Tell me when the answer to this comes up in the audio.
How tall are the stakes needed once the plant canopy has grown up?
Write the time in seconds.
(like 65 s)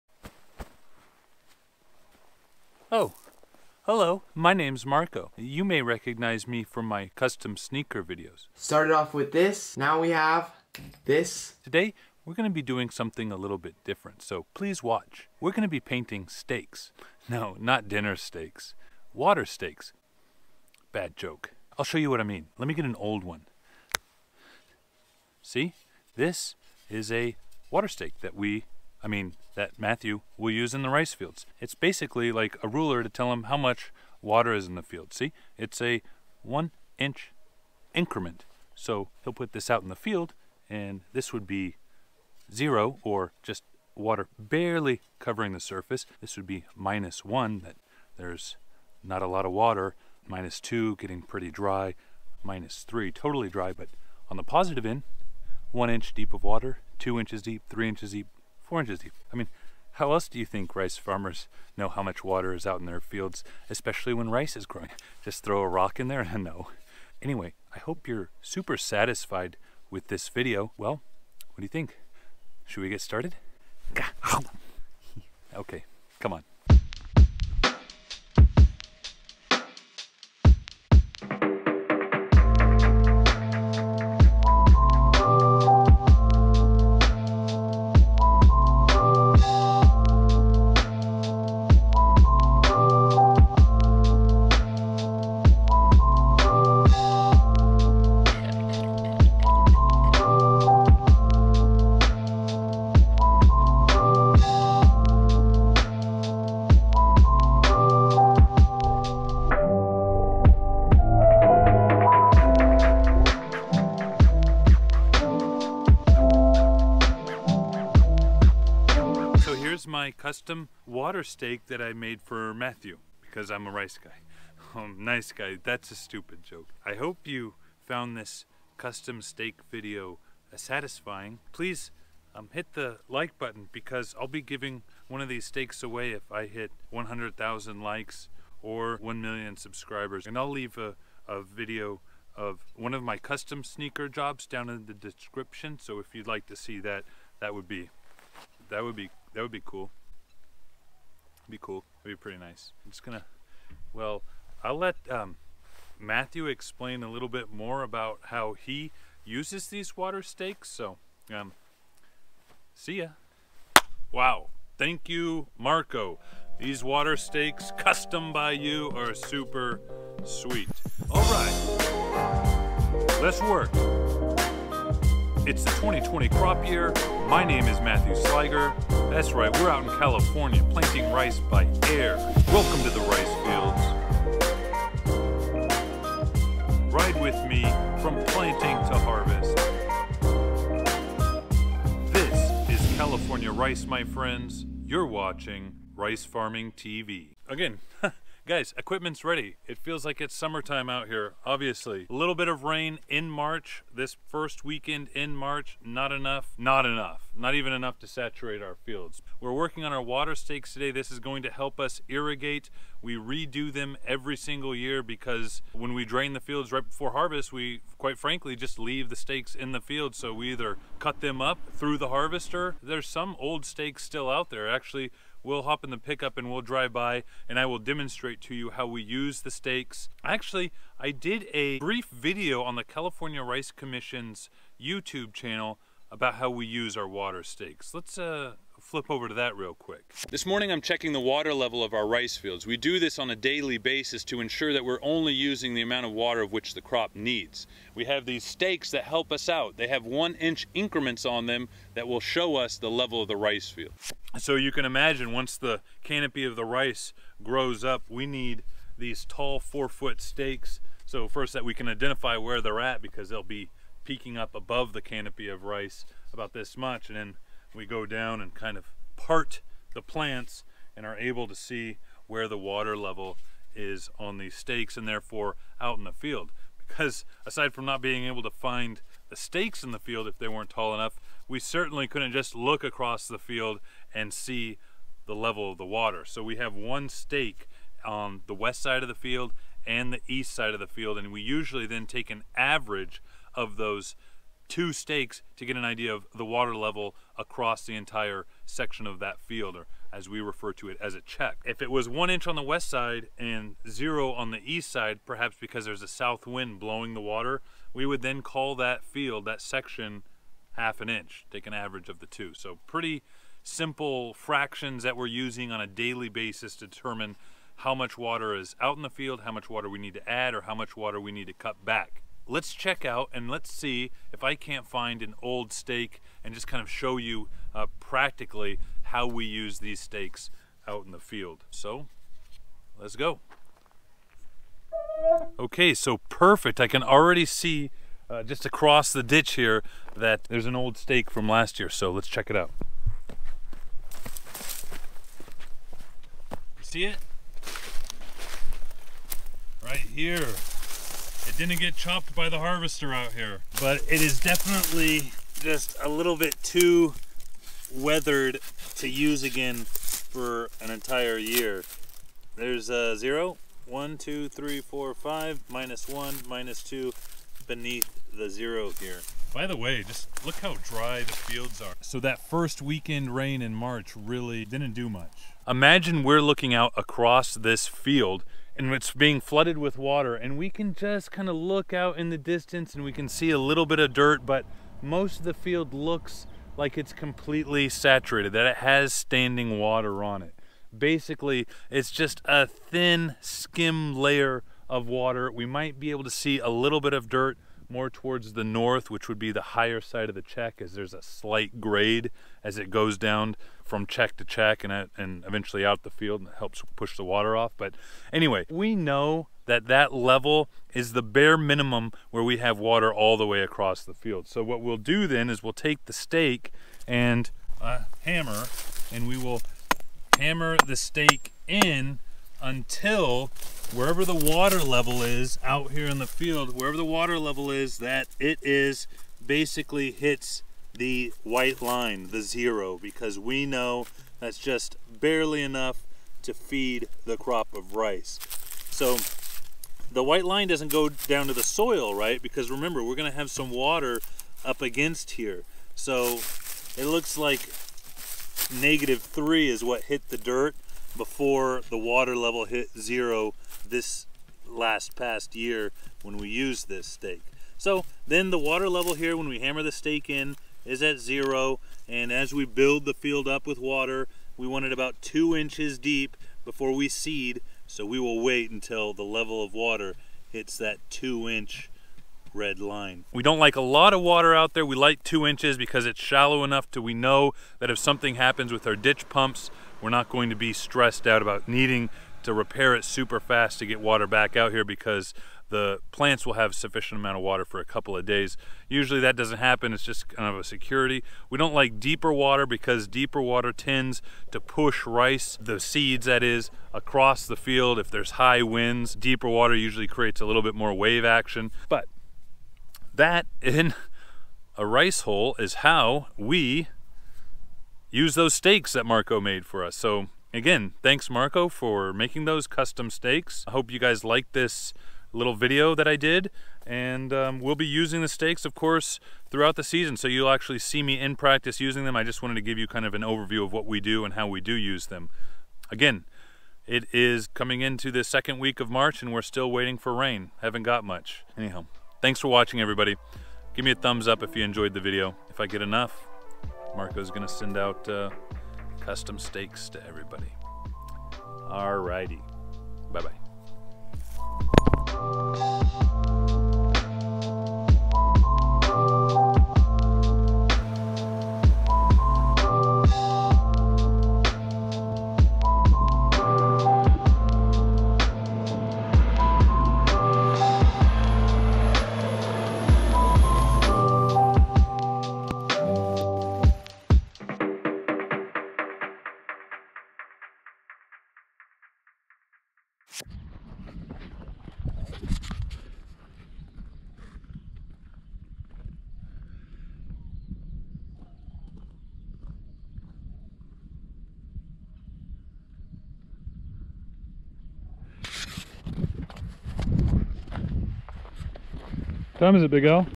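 259 s.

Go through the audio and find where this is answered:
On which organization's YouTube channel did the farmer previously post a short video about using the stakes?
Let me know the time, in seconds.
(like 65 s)
232 s.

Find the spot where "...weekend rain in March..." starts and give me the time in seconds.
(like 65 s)
372 s.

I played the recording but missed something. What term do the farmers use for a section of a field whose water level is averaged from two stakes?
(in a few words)
a check.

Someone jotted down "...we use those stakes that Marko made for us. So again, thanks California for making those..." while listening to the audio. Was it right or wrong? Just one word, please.
wrong.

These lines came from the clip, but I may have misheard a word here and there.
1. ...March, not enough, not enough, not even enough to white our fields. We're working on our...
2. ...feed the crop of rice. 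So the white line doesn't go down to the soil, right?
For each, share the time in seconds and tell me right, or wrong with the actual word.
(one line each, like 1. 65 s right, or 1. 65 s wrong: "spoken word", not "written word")
1. 205 s wrong: "saturate", not "white"
2. 436 s right.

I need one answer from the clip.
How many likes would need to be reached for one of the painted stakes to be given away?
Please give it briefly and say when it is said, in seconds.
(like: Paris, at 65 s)
100,000, at 136 s.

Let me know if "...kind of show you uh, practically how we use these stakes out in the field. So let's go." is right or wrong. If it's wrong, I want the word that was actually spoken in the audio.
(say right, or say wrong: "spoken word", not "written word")
right.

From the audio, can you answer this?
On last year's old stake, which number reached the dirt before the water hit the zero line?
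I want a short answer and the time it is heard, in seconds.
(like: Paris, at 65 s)
negative three, at 448 s.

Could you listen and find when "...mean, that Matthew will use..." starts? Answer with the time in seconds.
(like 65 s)
29 s.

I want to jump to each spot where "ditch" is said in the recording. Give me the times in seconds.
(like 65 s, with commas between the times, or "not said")
339 s, 478 s.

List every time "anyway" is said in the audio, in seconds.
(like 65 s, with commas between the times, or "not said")
67 s, 408 s.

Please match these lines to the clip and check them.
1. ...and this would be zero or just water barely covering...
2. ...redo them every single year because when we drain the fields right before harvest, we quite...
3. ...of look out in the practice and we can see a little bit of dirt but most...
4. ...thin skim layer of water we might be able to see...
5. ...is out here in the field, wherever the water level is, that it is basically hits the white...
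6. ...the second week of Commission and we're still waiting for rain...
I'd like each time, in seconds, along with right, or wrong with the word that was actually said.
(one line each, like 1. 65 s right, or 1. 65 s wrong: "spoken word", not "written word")
1. 40 s right
2. 213 s right
3. 381 s wrong: "distance", not "practice"
4. 392 s right
5. 425 s right
6. 528 s wrong: "March", not "Commission".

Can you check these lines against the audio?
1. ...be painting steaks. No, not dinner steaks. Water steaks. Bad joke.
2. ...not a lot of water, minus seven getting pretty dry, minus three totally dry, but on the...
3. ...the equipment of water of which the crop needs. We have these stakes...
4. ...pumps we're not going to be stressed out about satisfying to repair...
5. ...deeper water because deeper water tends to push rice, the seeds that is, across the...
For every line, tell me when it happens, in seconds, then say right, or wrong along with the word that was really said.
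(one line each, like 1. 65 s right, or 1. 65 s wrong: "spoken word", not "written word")
1. 15 s right
2. 49 s wrong: "two", not "seven"
3. 245 s wrong: "amount", not "equipment"
4. 479 s wrong: "needing", not "satisfying"
5. 491 s right.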